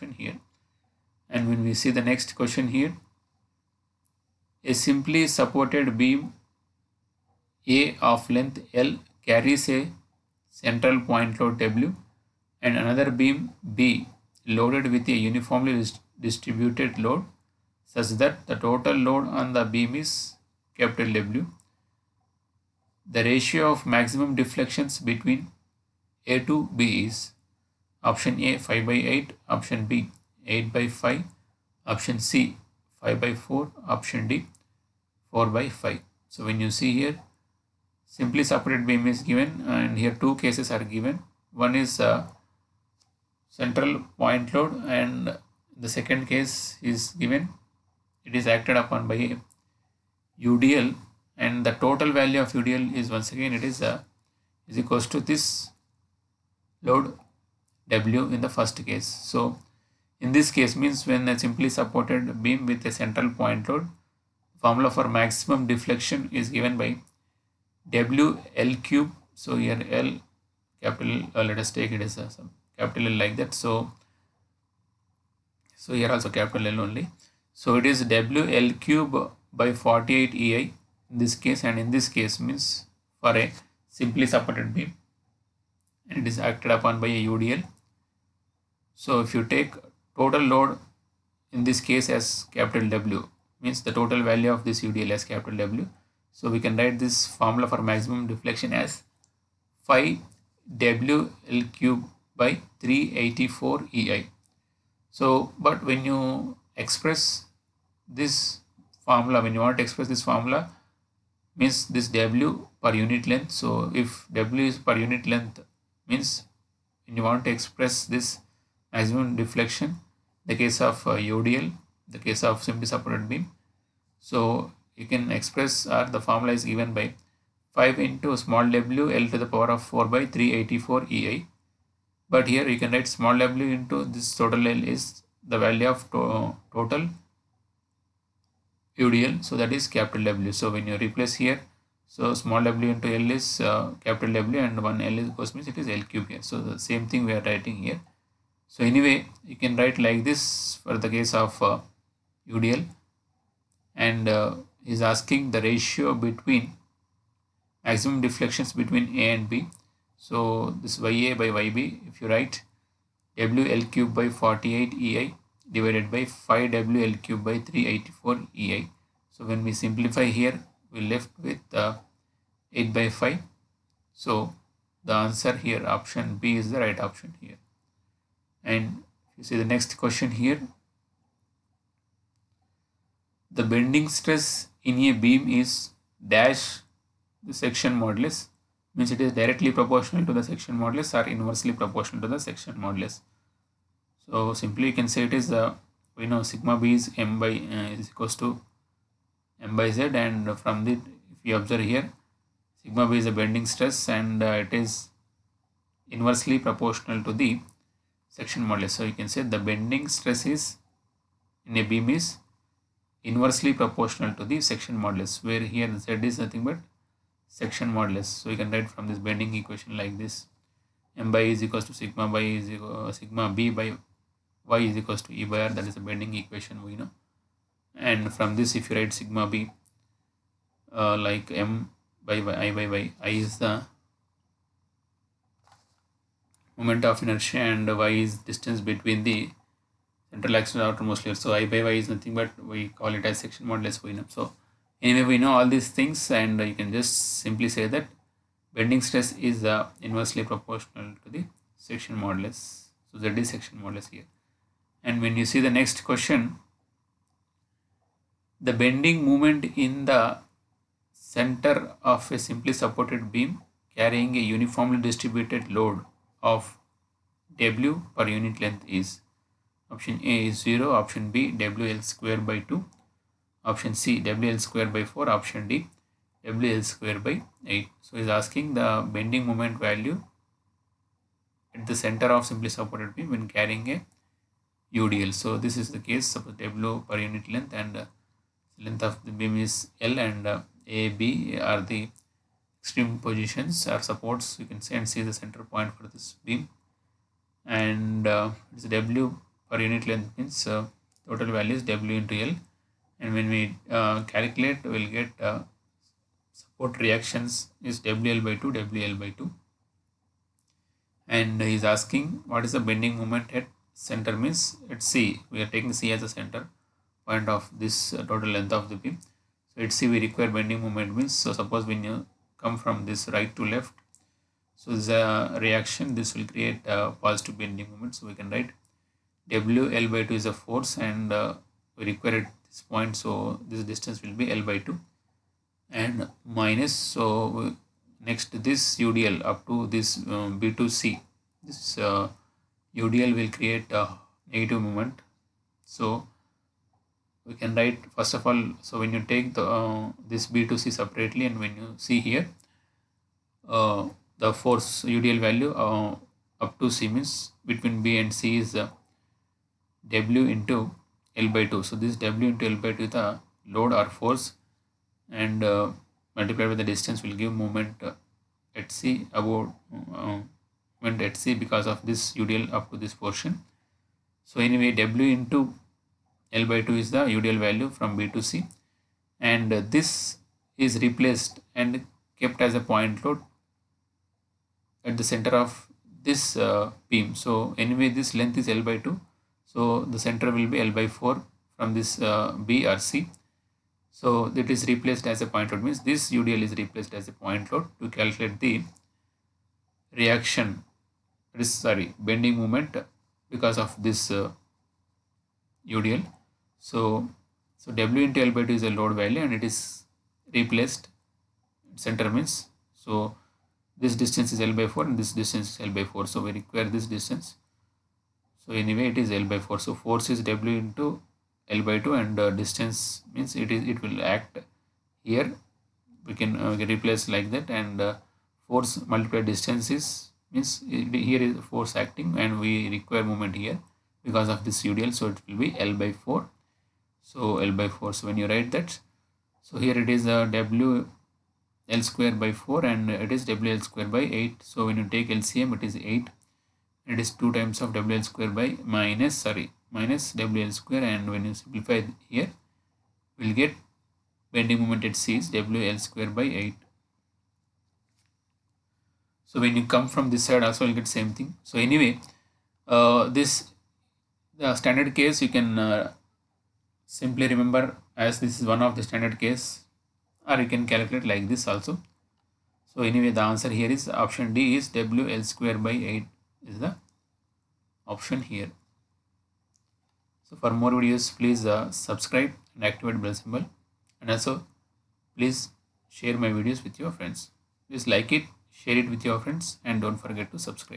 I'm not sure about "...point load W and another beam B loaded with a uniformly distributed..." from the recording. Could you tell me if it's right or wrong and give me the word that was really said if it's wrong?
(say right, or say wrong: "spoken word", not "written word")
right.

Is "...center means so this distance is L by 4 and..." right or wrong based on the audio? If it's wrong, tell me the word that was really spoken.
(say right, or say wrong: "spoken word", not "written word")
right.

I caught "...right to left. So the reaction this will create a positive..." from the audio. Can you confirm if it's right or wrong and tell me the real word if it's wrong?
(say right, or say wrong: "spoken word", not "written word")
right.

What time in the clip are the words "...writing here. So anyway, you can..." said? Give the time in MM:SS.
02:27.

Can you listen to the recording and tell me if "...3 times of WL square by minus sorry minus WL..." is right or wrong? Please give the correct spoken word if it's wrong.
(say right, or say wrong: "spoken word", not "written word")
wrong: "2", not "3".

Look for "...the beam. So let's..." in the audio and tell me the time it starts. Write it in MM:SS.
05:18.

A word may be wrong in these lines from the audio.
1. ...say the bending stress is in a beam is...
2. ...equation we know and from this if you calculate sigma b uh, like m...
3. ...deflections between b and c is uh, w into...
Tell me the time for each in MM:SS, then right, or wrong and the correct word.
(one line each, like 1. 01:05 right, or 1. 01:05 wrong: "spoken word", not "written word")
1. 03:29 right
2. 03:46 wrong: "write", not "calculate"
3. 05:57 wrong: "means", not "deflections".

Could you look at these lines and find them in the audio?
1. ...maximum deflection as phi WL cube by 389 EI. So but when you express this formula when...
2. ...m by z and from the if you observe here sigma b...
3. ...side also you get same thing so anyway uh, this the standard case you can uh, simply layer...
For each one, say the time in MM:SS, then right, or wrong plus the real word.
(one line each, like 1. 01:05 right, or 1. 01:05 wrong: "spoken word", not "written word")
1. 01:37 wrong: "384", not "389"
2. 03:19 right
3. 07:40 wrong: "remember", not "layer".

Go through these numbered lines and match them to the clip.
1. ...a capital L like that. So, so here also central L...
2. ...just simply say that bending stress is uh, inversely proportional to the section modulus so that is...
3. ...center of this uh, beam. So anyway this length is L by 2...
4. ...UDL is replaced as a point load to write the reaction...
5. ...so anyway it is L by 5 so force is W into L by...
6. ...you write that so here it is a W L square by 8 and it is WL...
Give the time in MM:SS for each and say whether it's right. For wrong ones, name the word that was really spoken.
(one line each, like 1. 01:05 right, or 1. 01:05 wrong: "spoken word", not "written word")
1. 01:12 wrong: "capital", not "central"
2. 04:06 right
3. 06:25 right
4. 06:36 wrong: "calculate", not "write"
5. 06:58 wrong: "4", not "5"
6. 07:18 wrong: "4", not "8".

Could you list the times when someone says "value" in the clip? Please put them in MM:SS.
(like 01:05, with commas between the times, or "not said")
00:52, 01:34, 02:15, 04:39, 05:01, 05:55, 06:17, 06:49.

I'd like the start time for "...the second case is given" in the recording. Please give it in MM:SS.
00:45.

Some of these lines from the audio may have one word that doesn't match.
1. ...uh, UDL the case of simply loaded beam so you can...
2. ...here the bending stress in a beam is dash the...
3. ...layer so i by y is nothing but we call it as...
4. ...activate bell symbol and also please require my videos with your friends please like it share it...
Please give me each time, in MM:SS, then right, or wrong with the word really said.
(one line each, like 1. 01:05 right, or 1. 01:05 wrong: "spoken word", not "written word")
1. 02:01 wrong: "supported", not "loaded"
2. 03:00 right
3. 04:01 right
4. 08:02 wrong: "share", not "require".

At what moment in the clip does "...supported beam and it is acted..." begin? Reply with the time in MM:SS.
01:24.